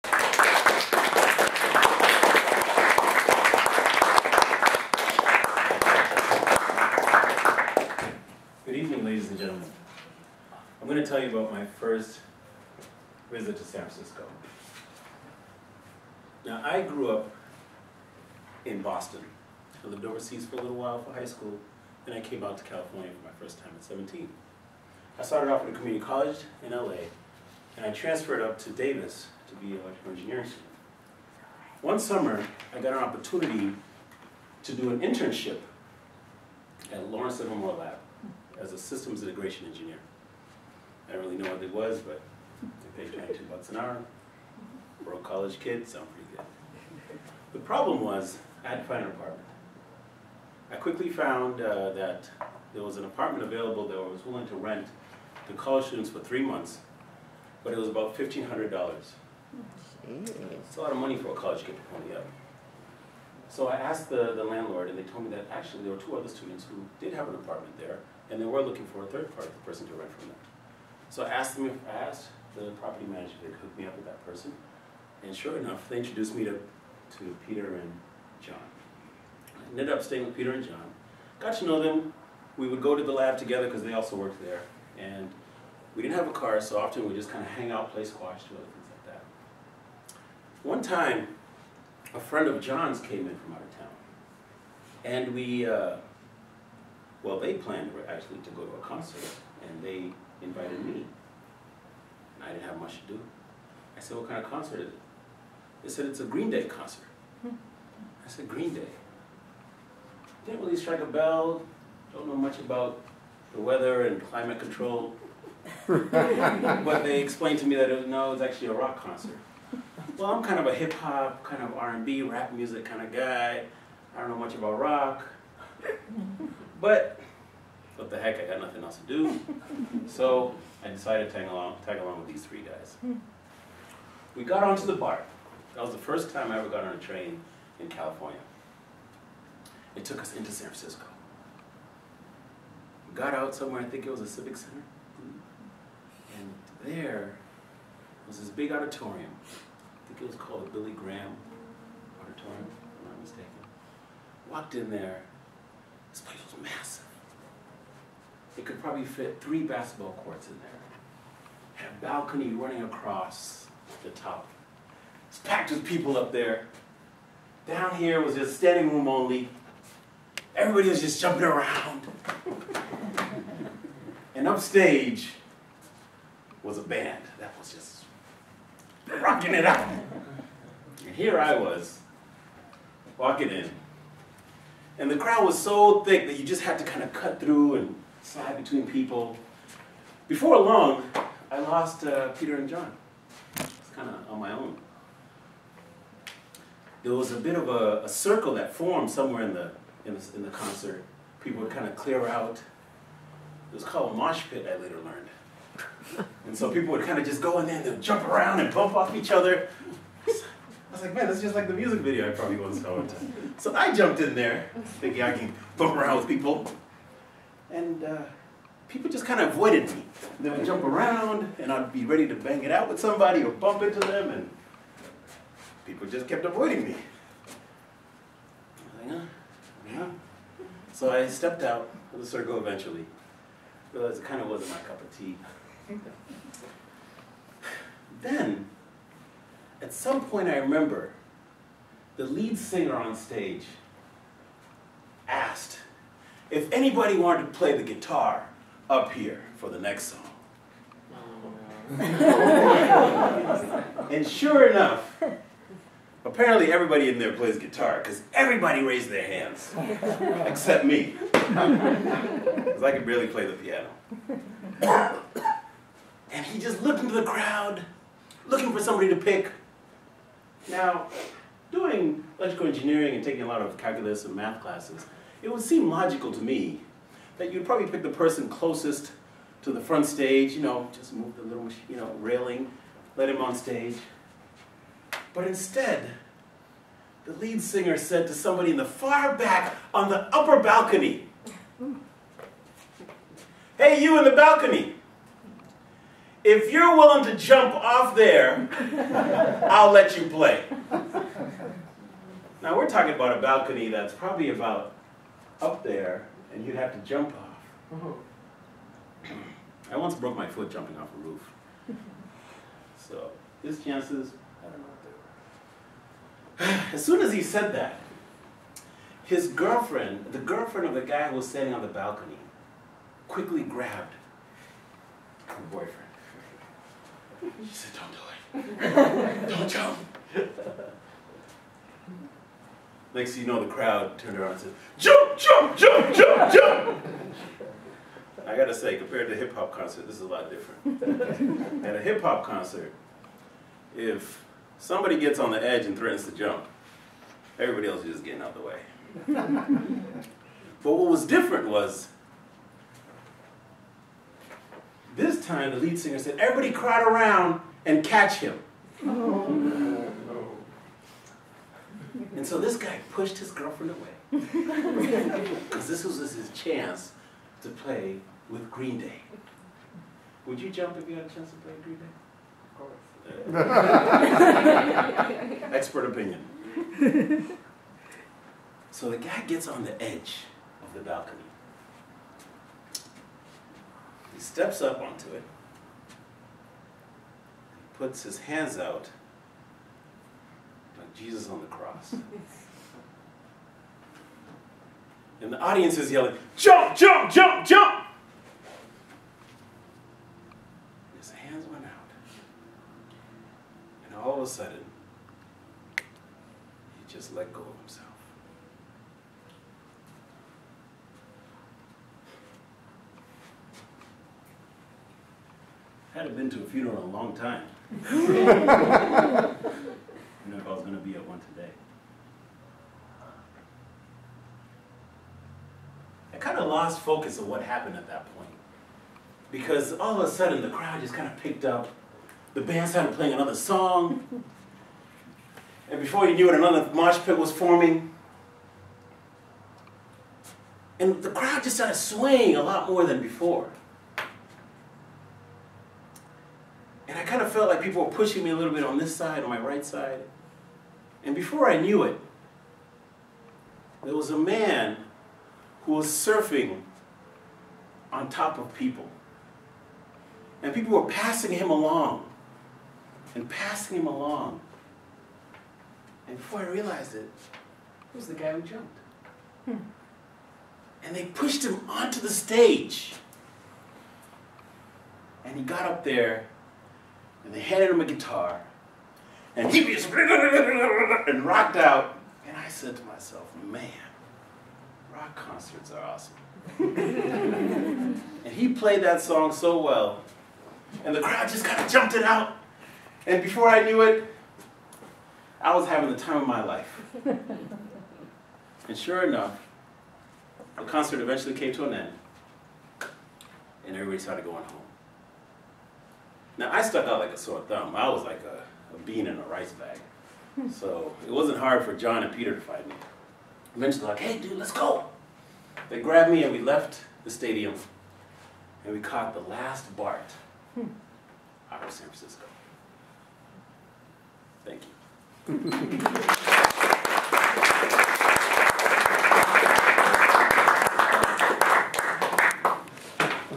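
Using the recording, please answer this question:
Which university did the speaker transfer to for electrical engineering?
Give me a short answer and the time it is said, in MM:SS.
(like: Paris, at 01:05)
Davis, at 00:28.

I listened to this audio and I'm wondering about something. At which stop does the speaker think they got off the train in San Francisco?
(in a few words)
Civic Center.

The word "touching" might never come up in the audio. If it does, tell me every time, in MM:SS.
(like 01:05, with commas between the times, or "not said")
not said.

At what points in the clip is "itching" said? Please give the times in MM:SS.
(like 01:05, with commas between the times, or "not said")
not said.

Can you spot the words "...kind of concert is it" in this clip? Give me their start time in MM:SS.
01:44.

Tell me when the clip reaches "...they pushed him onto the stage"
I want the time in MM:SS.
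07:51.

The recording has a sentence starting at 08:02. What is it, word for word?
And I said to myself, man, rock concerts are awesome.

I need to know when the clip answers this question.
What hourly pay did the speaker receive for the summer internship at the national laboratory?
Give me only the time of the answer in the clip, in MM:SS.
00:43.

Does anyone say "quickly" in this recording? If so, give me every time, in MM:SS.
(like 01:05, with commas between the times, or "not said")
00:50, 05:23.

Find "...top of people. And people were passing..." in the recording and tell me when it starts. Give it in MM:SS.
07:38.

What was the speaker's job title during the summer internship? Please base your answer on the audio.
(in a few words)
Systems integration engineer.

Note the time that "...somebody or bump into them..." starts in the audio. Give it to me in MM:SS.
03:42.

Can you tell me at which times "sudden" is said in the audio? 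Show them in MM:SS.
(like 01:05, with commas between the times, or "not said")
06:44, 07:10.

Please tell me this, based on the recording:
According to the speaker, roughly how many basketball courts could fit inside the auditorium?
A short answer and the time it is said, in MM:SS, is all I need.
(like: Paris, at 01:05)
3, at 02:39.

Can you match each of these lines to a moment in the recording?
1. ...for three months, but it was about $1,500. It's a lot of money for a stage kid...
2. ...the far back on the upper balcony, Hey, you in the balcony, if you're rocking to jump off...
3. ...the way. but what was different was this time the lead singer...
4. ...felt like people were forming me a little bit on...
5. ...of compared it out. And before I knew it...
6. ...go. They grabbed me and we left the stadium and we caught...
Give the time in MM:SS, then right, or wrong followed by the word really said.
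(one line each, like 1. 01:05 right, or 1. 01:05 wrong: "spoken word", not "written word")
1. 00:56 wrong: "college", not "stage"
2. 04:48 wrong: "willing", not "rocking"
3. 05:48 right
4. 07:27 wrong: "pushing", not "forming"
5. 08:11 wrong: "jumped", not "compared"
6. 08:34 right.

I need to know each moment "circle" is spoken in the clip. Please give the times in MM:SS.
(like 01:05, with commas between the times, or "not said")
03:18, 03:52.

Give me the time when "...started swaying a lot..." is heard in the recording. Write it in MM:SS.
07:21.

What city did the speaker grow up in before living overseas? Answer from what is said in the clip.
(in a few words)
Boston.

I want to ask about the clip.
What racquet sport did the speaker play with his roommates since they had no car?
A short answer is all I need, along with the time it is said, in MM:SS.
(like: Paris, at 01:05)
Squash, at 01:28.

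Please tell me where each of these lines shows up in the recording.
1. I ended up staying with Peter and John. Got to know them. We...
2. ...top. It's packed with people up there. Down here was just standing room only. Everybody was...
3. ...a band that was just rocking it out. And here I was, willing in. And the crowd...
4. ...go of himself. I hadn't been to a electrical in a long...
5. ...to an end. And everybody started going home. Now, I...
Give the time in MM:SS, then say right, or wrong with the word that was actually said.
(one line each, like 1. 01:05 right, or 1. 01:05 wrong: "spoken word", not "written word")
1. 01:19 right
2. 02:44 right
3. 02:56 wrong: "walking", not "willing"
4. 06:47 wrong: "funeral", not "electrical"
5. 08:21 right.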